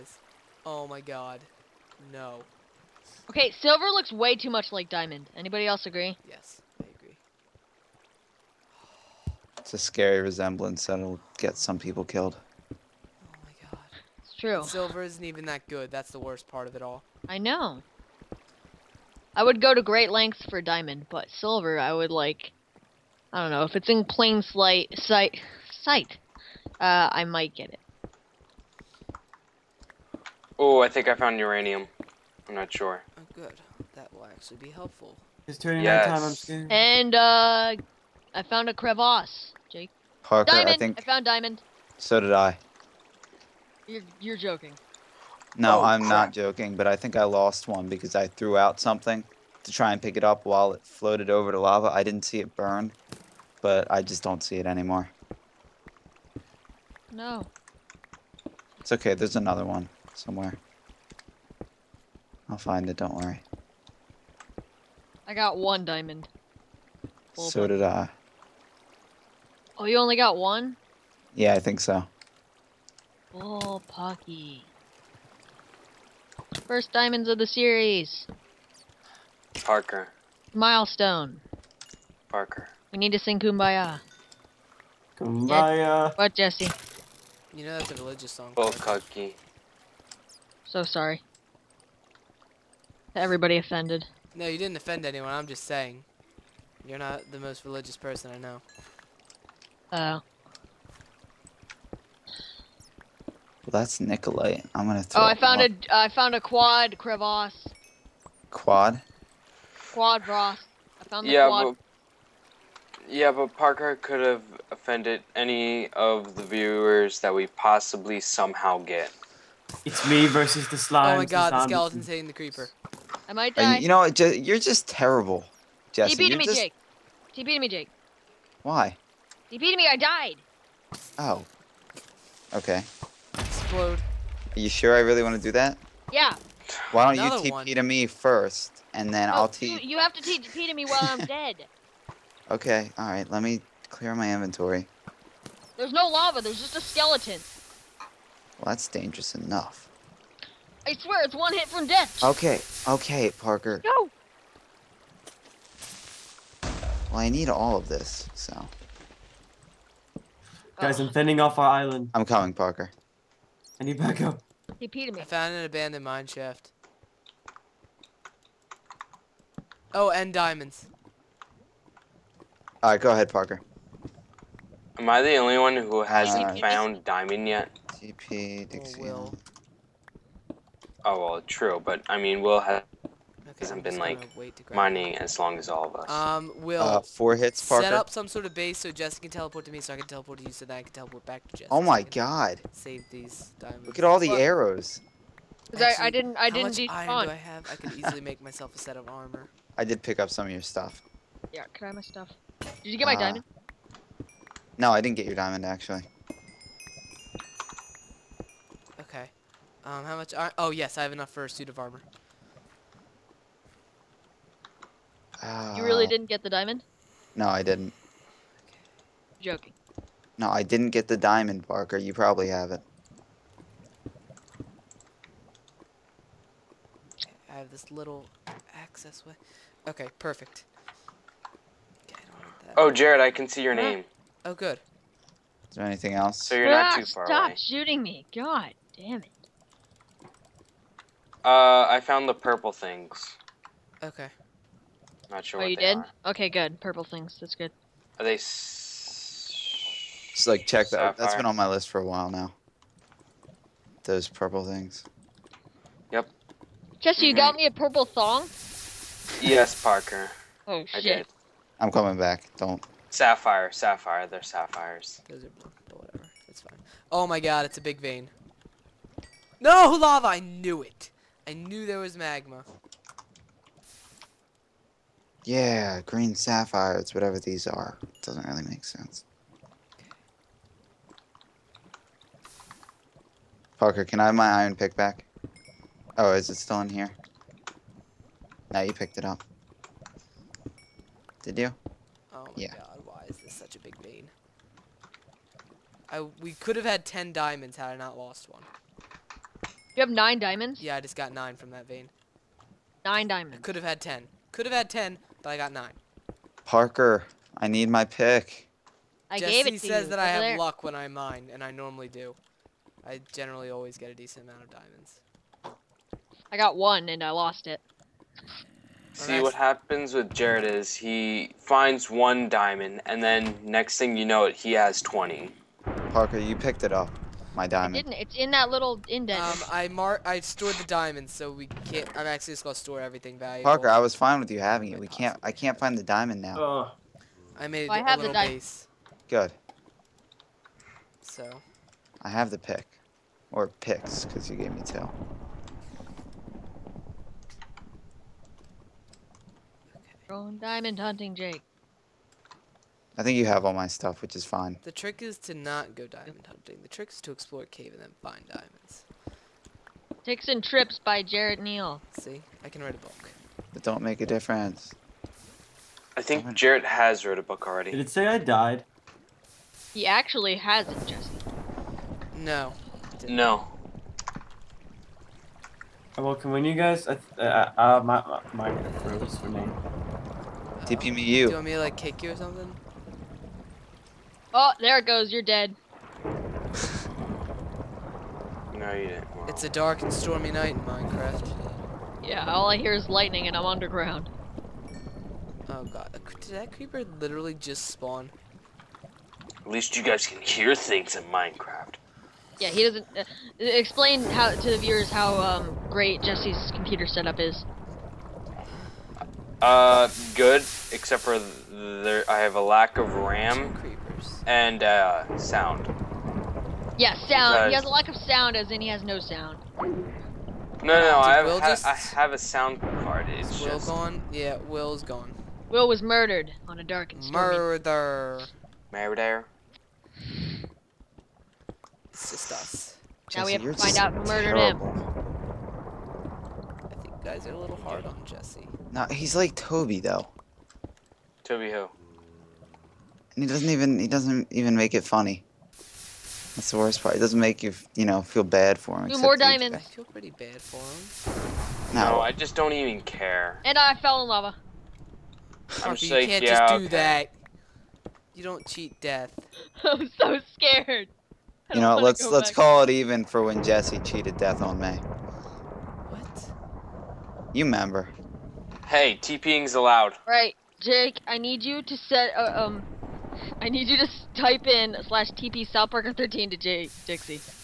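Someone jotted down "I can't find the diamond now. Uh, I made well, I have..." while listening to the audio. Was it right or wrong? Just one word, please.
right.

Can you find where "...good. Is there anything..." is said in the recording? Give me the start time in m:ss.
3:54.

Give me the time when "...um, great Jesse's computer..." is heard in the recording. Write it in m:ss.
6:45.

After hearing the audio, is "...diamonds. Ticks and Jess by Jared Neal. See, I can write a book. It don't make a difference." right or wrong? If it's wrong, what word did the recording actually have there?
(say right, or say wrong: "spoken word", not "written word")
wrong: "Trips", not "Jess".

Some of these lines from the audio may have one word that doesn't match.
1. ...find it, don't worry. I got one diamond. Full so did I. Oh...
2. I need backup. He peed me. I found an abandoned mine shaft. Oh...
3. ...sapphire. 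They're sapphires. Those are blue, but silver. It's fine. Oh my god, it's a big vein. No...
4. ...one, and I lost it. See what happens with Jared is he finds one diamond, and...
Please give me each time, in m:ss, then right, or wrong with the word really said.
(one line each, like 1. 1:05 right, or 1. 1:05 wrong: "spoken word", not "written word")
1. 1:02 right
2. 2:43 right
3. 4:23 wrong: "whatever", not "silver"
4. 5:16 right.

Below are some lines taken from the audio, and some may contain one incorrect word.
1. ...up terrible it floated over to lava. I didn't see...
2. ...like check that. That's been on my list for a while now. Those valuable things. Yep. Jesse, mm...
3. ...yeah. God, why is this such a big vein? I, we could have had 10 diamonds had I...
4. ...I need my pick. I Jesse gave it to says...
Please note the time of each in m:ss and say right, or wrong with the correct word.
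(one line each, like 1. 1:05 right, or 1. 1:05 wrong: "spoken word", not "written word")
1. 0:50 wrong: "while", not "terrible"
2. 4:10 wrong: "purple", not "valuable"
3. 4:52 right
4. 5:07 right.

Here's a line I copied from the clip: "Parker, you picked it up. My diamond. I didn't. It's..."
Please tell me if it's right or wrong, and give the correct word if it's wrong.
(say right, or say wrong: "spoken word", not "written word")
right.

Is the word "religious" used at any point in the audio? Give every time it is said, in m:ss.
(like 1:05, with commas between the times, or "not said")
1:27, 1:37.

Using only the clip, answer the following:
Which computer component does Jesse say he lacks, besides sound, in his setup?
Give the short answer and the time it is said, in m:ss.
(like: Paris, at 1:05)
RAM, at 6:53.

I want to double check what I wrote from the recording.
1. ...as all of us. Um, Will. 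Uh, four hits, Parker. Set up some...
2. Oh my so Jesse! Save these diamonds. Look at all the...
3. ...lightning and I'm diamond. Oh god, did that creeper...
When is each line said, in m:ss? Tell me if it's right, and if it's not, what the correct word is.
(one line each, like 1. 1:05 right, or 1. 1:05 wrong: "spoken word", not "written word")
1. 3:05 right
2. 3:11 wrong: "God", not "Jesse"
3. 6:33 wrong: "underground", not "diamond".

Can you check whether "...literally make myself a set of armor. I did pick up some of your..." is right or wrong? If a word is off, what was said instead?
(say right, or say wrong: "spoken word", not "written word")
wrong: "easily", not "literally".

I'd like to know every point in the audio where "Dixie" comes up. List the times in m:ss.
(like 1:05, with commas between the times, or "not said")
2:58, 7:57.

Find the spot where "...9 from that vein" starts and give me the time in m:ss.
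5:01.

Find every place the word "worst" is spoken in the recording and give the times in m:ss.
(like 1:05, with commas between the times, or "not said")
0:16, 7:26.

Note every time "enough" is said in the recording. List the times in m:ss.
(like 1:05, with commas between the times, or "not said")
2:29, 3:31.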